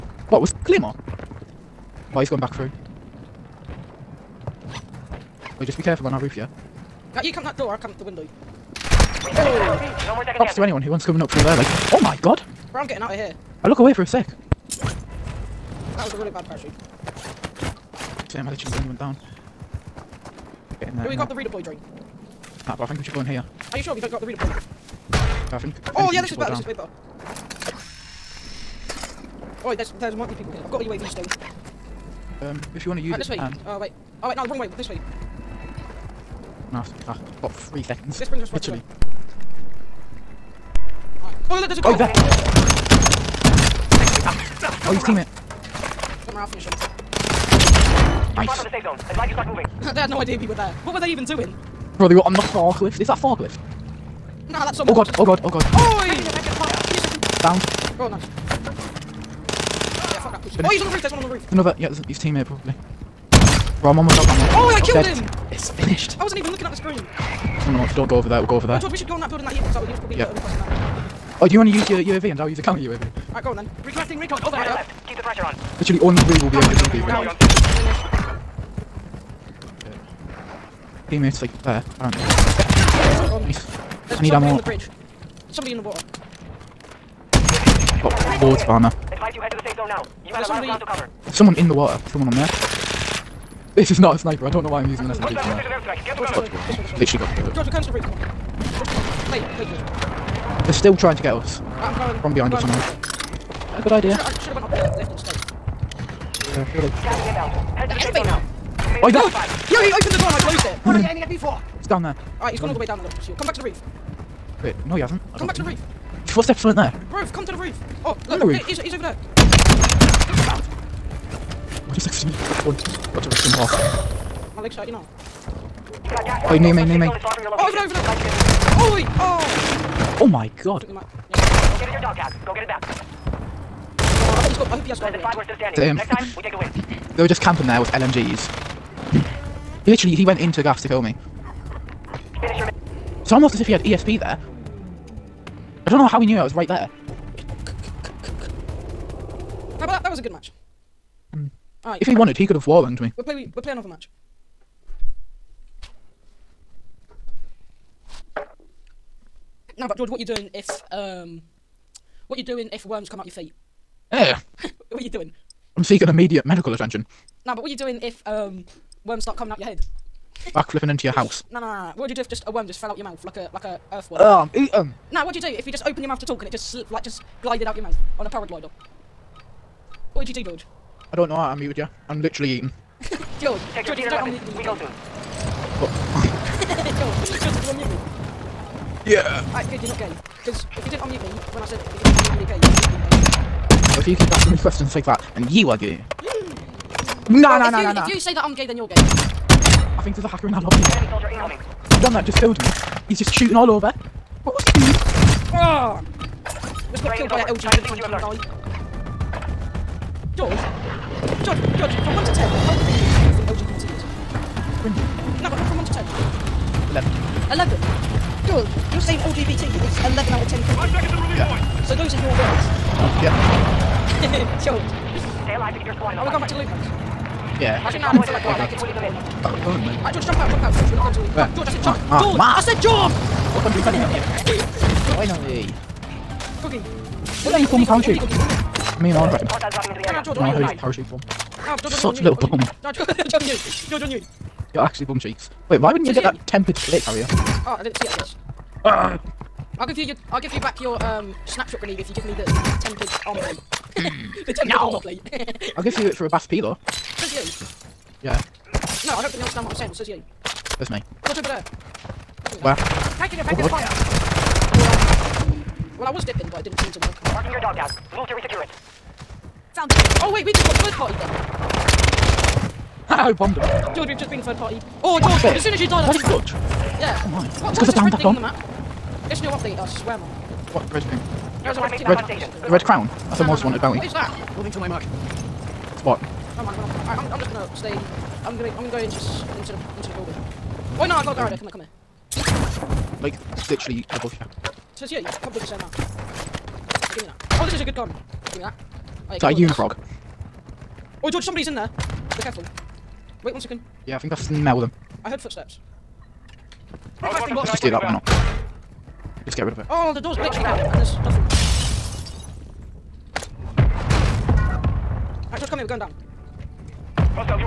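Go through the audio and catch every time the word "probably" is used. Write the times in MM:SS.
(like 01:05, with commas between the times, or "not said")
01:02, 01:09.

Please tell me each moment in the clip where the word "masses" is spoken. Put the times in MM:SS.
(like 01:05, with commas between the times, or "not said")
not said.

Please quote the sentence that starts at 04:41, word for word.
Your no, squad mate's red, on station.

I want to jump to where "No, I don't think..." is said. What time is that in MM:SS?
04:19.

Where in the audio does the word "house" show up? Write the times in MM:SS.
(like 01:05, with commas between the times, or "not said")
02:51, 03:46.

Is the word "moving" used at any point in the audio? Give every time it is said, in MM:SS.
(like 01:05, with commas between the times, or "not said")
00:49, 04:44.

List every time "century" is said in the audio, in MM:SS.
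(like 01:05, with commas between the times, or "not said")
not said.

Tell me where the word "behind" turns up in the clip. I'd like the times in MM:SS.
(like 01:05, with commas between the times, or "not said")
01:42.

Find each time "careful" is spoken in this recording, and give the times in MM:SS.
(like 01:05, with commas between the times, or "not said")
00:05, 05:02.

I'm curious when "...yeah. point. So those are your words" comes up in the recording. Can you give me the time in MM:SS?
03:41.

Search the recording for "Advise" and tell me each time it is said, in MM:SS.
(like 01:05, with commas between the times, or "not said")
00:49, 01:29.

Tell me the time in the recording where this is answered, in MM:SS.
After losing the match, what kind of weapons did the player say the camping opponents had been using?
02:17.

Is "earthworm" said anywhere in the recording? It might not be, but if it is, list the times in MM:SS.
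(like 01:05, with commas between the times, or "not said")
02:53.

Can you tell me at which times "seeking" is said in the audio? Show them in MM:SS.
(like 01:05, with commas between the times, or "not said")
02:45.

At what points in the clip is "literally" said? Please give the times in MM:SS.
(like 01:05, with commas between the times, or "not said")
00:18, 00:38, 01:15, 01:36, 02:19, 03:02, 04:53.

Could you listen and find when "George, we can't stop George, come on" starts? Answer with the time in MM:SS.
01:37.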